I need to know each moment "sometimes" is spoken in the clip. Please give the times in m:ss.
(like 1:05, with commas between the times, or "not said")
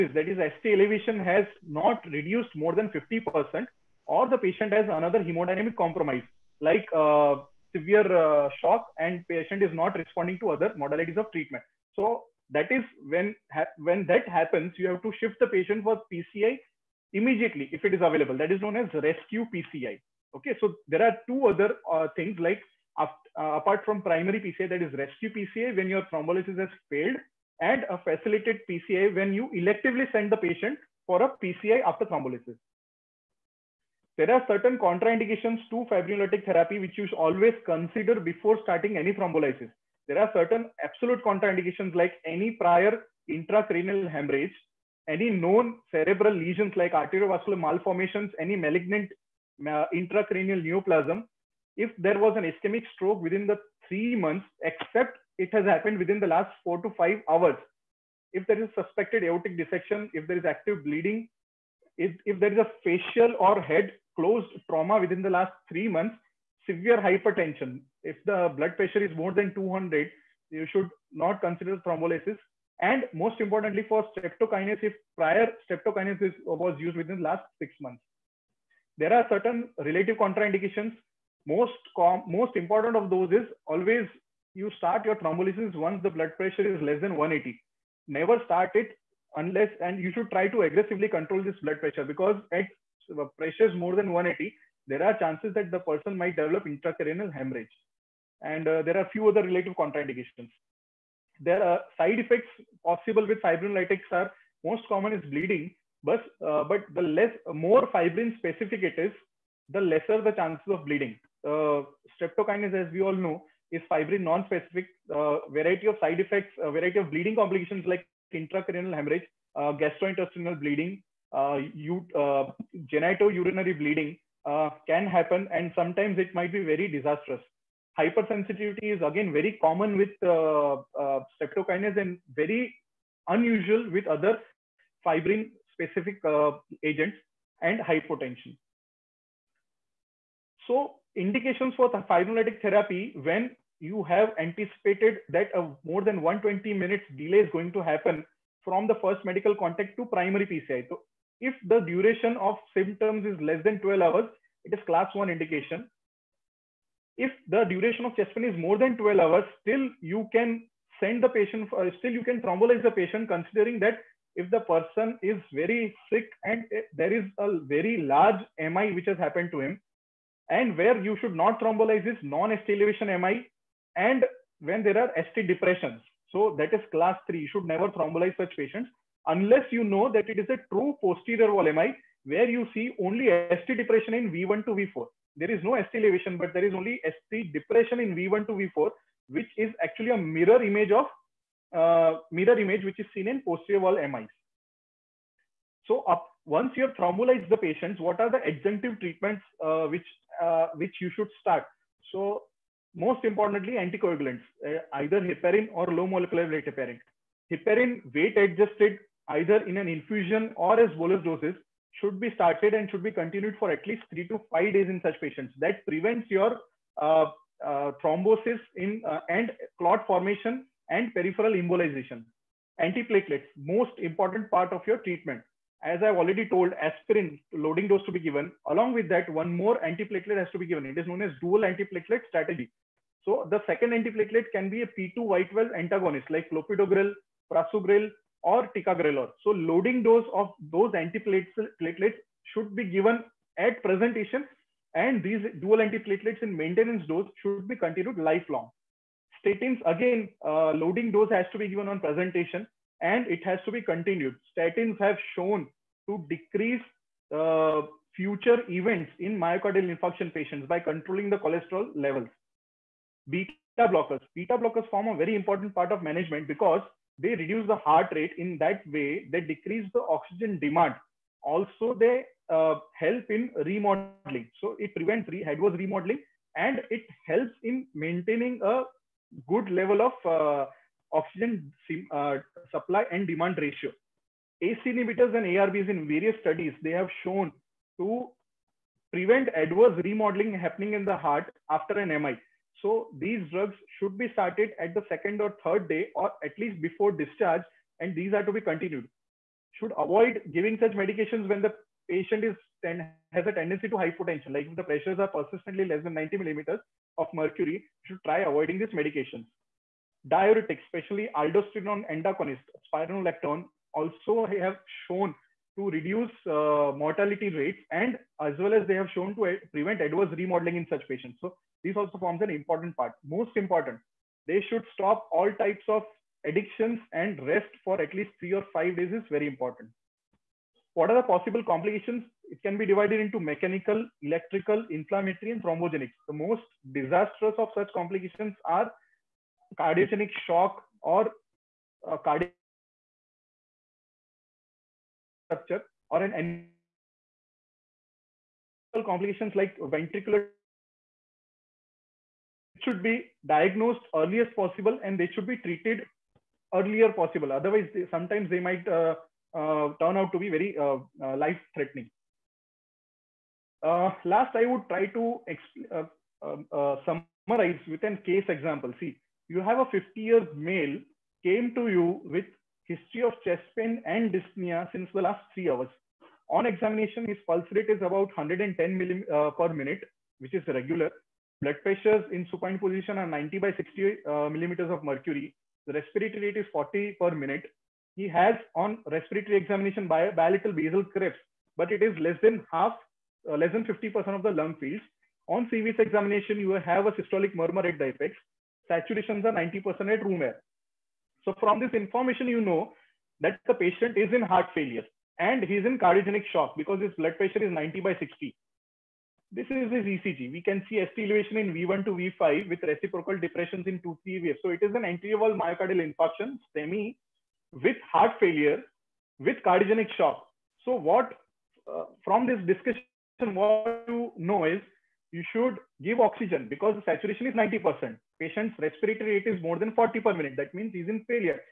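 2:05, 5:58.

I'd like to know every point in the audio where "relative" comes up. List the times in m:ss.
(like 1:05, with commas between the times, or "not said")
1:19, 1:39.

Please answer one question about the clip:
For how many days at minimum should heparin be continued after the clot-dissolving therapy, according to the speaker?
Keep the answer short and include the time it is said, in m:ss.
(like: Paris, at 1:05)
3 to 5, at 3:34.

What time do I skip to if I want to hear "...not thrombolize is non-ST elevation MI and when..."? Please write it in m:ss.
2:51.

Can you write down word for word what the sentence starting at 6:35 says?
On CVS examination, you have a systolic murmur at the apex.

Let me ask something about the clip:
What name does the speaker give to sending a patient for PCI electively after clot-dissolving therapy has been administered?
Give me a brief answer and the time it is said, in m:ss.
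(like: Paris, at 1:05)
facilitated PCI, at 0:27.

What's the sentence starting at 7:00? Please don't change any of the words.
So what, uh, from this discussion, what you know is you should give oxygen because the saturation is 90%.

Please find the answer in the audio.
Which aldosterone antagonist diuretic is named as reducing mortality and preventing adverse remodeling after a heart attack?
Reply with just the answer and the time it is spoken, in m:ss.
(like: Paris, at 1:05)
spironolactone, at 5:12.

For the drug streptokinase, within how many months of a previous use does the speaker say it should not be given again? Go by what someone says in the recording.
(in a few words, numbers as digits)
6.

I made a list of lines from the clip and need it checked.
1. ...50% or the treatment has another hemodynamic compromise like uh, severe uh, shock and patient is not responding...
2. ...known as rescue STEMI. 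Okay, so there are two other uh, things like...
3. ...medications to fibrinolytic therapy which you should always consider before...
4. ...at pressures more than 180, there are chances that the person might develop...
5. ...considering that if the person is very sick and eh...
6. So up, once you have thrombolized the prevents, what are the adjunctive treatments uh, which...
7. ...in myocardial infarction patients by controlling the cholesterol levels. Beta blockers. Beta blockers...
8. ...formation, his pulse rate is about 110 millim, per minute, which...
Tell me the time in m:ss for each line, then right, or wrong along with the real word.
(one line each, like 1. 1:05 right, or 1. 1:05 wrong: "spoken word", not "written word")
1. 0:02 wrong: "patient", not "treatment"
2. 0:18 wrong: "PCI", not "STEMI"
3. 0:34 wrong: "contraindications", not "medications"
4. 1:32 right
5. 2:43 right
6. 3:15 wrong: "patients", not "prevents"
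7. 4:19 right
8. 6:16 wrong: "examination", not "formation".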